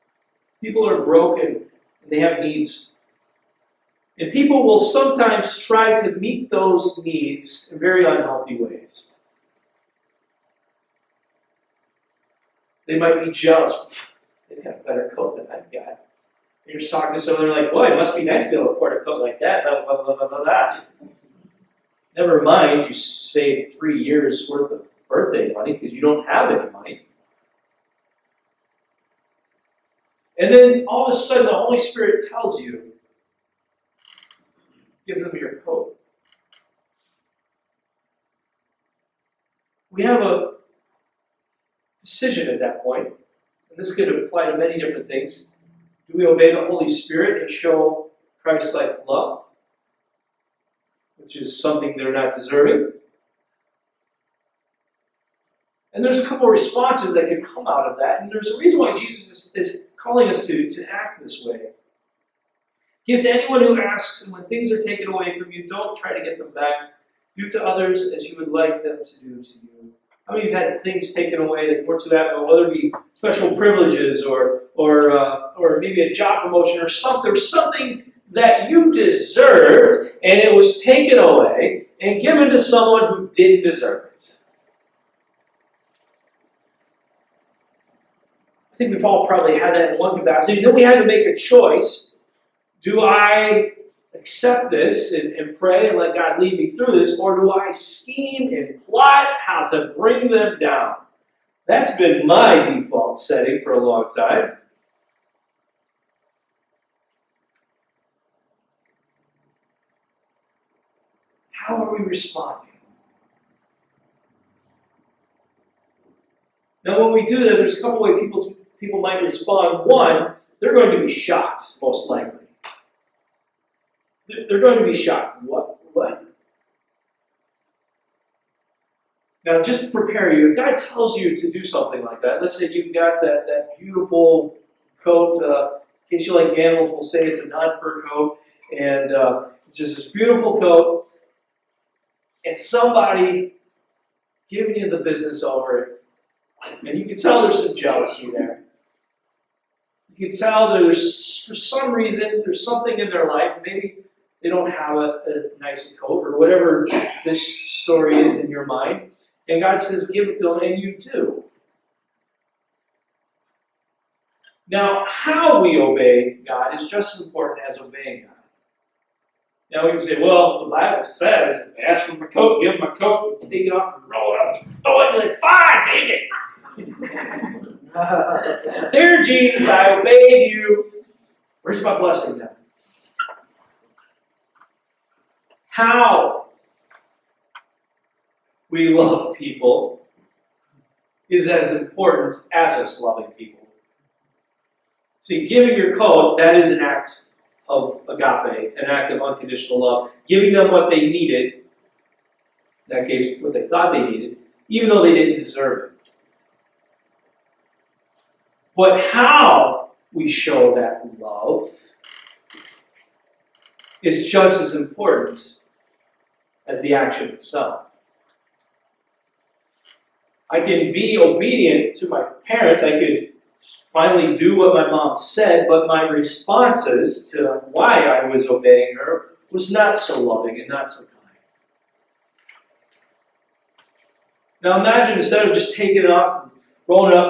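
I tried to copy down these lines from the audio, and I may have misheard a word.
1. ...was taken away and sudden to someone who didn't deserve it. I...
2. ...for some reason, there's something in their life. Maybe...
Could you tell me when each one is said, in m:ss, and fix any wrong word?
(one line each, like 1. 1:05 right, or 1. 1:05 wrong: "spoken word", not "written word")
1. 1:20 wrong: "given", not "sudden"
2. 2:31 right.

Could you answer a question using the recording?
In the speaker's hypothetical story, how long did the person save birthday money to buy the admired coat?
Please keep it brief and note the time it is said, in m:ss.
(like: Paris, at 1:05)
3 years, at 0:23.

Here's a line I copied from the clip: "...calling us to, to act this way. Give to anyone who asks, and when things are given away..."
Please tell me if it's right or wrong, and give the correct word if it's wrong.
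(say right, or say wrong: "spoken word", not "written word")
wrong: "taken", not "given".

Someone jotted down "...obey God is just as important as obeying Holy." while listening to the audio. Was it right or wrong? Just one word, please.
wrong.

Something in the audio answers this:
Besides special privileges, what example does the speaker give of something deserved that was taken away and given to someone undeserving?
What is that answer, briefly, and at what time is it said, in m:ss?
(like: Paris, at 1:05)
Job promotion, at 1:16.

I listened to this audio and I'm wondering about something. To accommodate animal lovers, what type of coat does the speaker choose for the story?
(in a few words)
Non-fur coat.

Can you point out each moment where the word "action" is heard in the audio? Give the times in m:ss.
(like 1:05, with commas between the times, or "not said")
3:36.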